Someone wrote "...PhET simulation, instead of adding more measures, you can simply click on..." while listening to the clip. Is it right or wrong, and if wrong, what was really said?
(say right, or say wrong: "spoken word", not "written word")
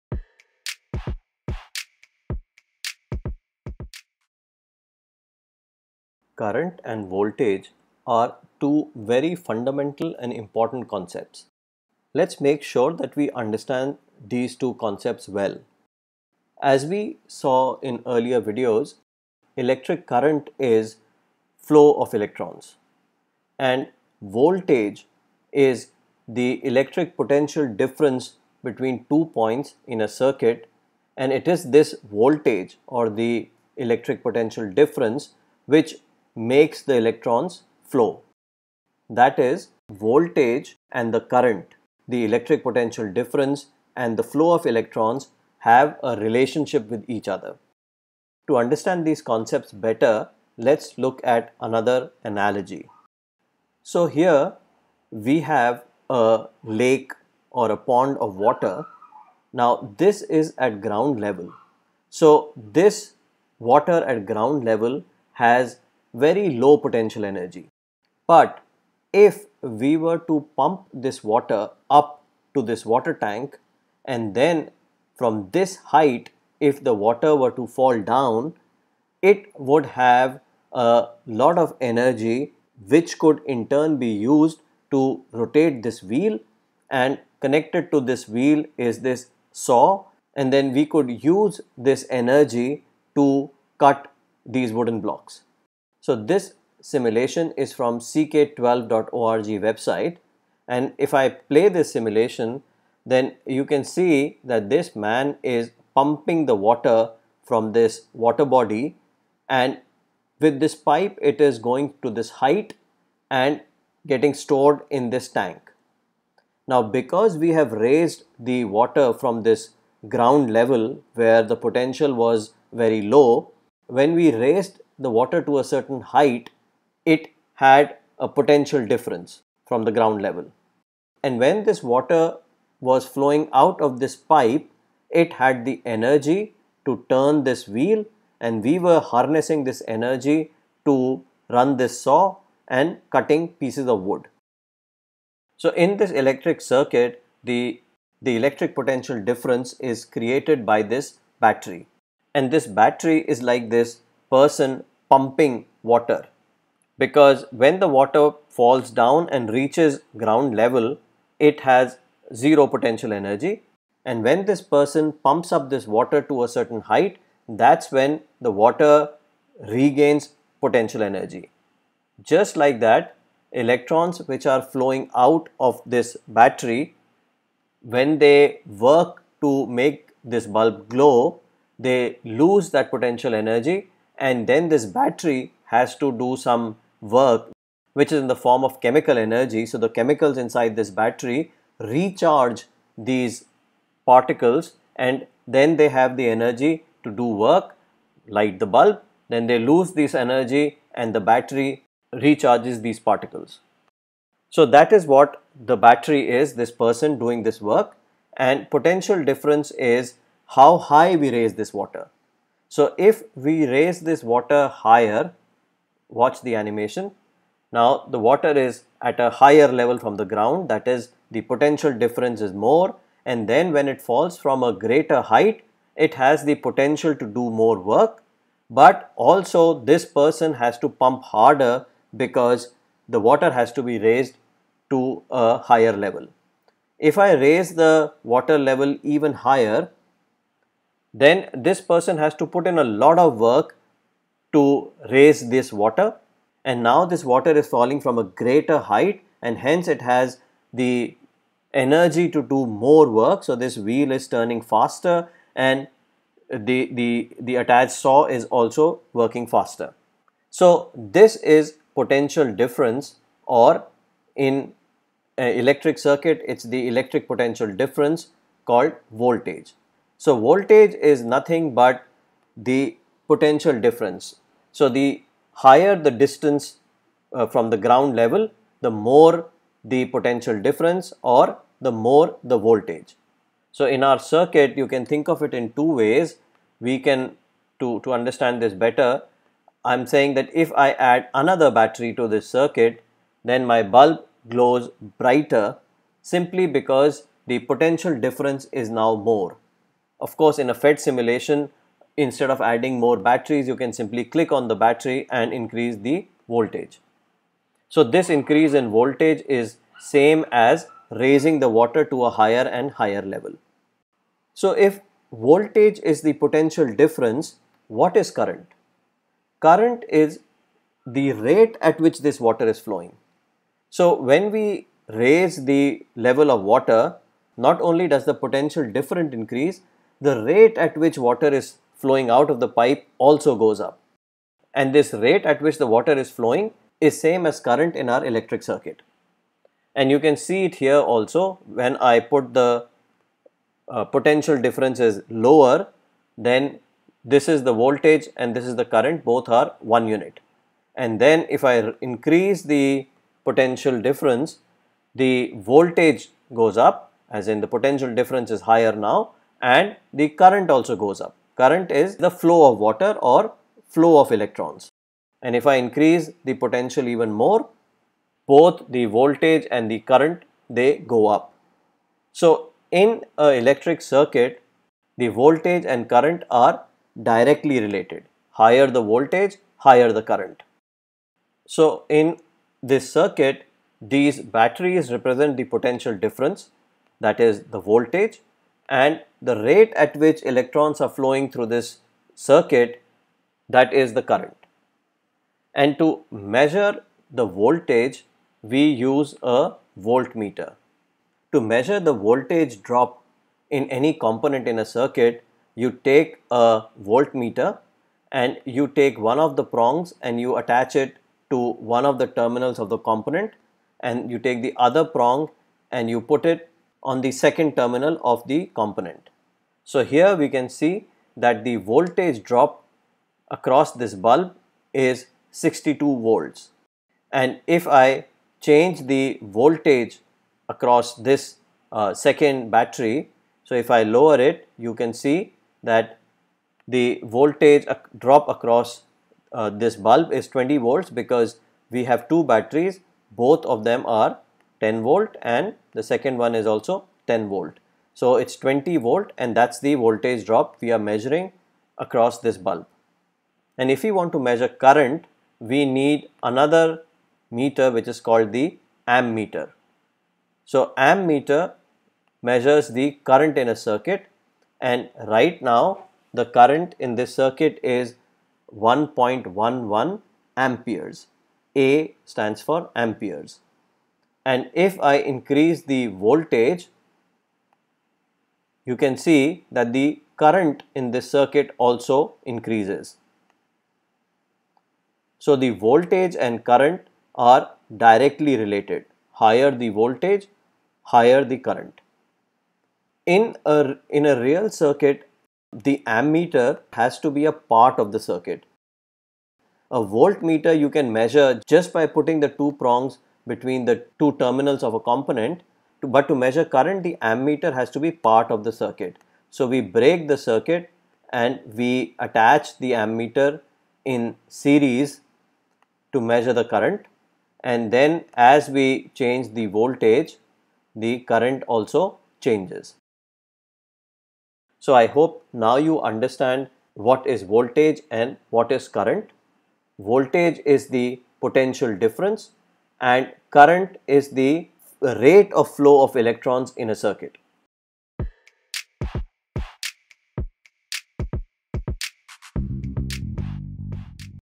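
wrong: "batteries", not "measures".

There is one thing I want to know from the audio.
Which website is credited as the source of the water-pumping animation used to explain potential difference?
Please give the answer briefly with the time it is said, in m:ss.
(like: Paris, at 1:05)
ck12.org, at 1:37.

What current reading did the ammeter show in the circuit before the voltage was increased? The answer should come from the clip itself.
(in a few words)
1.11 amperes.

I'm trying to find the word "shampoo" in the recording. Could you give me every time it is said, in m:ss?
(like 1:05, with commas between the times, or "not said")
not said.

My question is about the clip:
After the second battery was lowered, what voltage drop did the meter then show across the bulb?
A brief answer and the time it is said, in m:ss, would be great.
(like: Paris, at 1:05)
20 volts, at 7:20.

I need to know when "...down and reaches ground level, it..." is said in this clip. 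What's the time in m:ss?
2:38.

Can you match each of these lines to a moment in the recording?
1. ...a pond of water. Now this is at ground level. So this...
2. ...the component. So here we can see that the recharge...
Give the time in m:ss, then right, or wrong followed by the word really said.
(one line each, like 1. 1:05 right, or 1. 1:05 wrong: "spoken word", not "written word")
1. 0:57 right
2. 6:58 wrong: "voltage", not "recharge".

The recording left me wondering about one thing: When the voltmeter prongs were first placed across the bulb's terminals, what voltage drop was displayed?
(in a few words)
62 volts.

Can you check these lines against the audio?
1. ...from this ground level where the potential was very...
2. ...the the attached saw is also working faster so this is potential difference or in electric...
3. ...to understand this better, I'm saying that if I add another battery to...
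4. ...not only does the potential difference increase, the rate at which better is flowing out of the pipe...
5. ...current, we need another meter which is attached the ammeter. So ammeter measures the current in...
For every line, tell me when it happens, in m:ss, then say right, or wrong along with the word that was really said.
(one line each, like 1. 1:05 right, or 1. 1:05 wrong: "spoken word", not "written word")
1. 1:59 right
2. 4:16 right
3. 4:48 right
4. 5:27 wrong: "water", not "better"
5. 7:34 wrong: "called", not "attached".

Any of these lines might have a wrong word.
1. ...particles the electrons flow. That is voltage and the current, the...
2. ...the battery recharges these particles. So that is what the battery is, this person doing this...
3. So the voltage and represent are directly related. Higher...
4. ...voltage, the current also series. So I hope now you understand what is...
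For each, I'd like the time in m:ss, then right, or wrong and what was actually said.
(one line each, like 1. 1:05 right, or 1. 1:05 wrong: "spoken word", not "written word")
1. 0:36 wrong: "makes", not "particles"
2. 3:21 right
3. 8:05 wrong: "current", not "represent"
4. 8:39 wrong: "changes", not "series".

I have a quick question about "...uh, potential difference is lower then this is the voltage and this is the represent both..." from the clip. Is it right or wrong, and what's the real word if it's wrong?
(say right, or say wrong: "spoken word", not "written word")
wrong: "current", not "represent".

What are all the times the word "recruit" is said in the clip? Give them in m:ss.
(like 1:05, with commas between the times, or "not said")
not said.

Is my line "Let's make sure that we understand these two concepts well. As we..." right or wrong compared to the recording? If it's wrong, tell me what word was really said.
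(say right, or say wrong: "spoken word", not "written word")
right.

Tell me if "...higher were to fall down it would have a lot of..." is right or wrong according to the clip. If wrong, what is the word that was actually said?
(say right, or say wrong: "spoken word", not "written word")
wrong: "water", not "higher".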